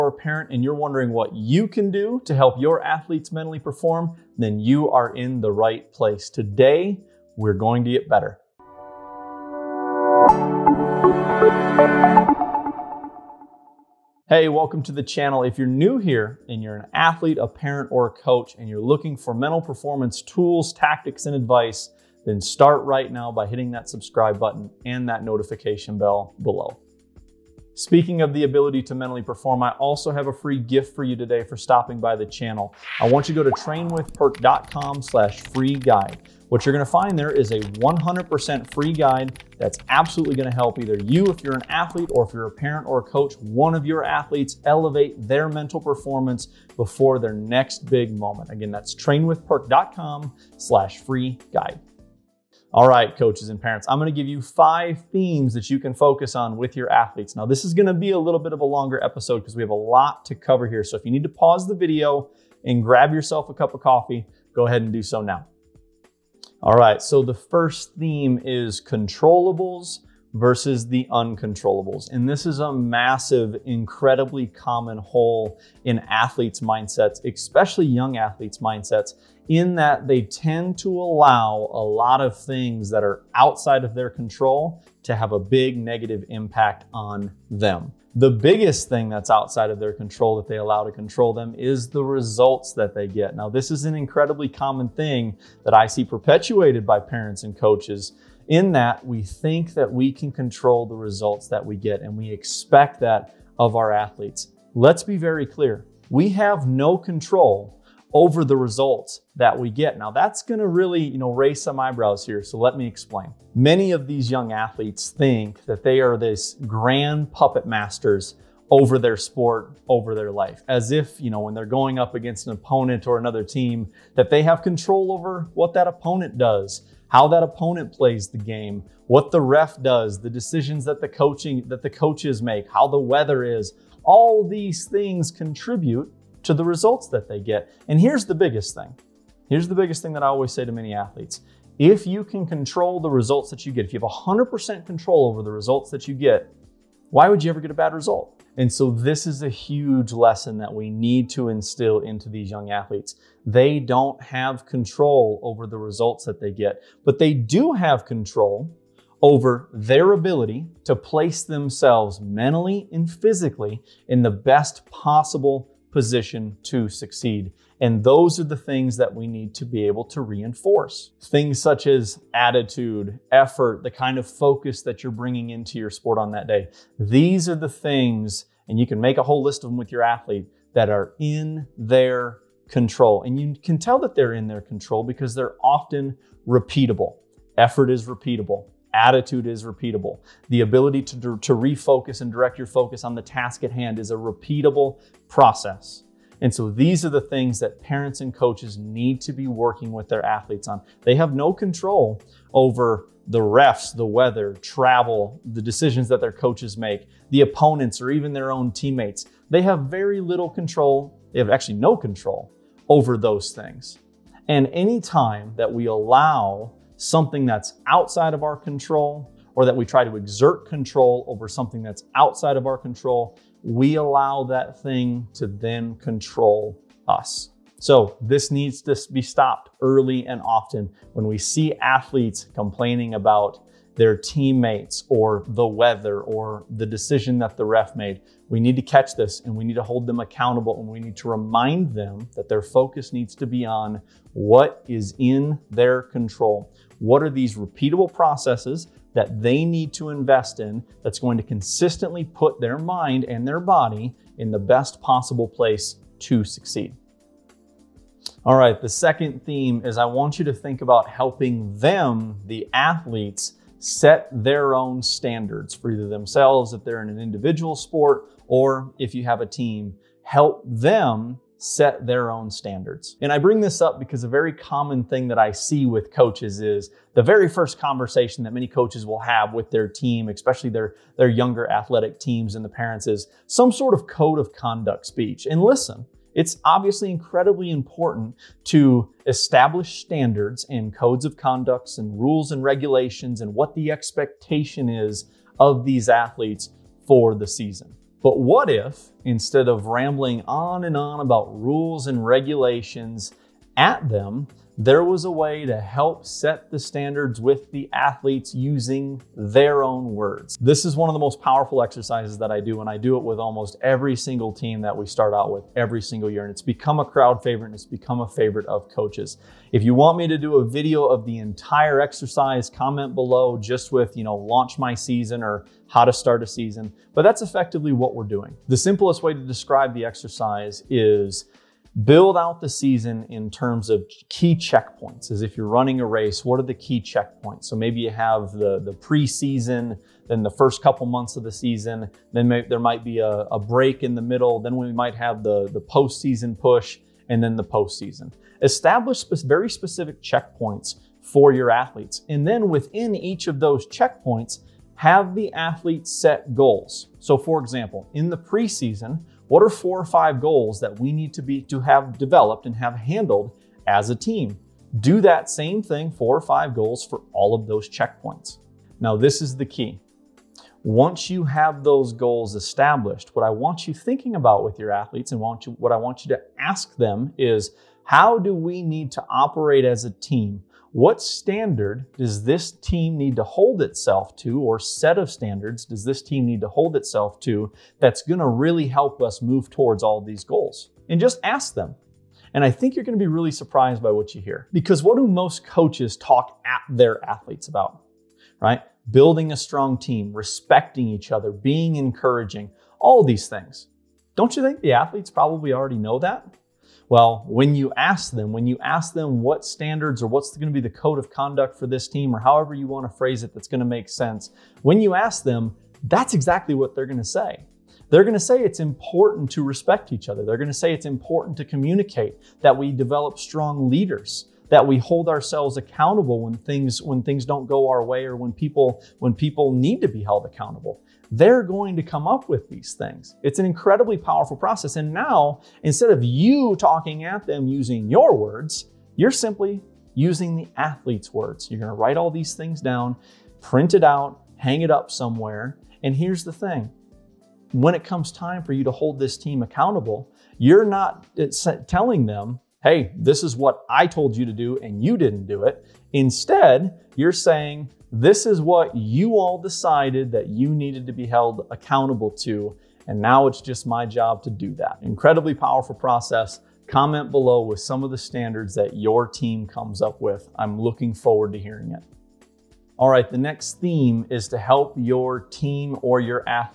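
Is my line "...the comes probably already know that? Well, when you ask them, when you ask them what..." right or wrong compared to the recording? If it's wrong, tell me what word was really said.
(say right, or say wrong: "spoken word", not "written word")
wrong: "athletes", not "comes".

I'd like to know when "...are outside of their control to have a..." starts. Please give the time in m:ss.
1:23.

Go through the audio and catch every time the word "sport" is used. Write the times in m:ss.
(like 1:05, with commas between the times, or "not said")
1:59, 2:55, 4:27.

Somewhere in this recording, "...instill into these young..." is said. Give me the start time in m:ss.
2:31.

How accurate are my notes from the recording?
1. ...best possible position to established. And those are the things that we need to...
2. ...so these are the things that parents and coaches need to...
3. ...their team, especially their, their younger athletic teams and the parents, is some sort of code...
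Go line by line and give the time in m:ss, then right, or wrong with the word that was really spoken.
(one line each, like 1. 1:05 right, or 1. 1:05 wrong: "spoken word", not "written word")
1. 2:44 wrong: "succeed", not "established"
2. 3:16 right
3. 4:39 right.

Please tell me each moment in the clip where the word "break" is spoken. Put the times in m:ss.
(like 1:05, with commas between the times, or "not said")
5:43.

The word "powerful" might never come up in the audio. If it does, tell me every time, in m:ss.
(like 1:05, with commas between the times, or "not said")
5:11, 7:14, 7:45.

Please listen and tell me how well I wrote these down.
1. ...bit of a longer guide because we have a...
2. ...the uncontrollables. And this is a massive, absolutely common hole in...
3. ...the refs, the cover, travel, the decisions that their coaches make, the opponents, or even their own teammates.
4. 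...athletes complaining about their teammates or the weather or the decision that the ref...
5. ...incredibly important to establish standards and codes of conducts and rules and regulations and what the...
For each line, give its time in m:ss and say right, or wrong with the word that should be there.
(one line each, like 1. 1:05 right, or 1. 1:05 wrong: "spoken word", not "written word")
1. 0:58 wrong: "episode", not "guide"
2. 1:10 wrong: "incredibly", not "absolutely"
3. 3:23 wrong: "weather", not "cover"
4. 3:51 right
5. 4:47 right.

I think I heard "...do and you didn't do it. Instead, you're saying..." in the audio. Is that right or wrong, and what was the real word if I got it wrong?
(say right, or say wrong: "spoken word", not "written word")
right.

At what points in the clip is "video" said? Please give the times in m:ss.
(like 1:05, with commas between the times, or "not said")
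1:01, 5:20.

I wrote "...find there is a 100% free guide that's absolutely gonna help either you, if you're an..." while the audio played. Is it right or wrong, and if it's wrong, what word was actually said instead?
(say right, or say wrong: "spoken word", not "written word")
right.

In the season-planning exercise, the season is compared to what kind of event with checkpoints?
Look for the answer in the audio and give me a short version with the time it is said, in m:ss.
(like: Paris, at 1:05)
A race, at 5:35.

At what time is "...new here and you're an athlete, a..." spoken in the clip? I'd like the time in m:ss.
0:15.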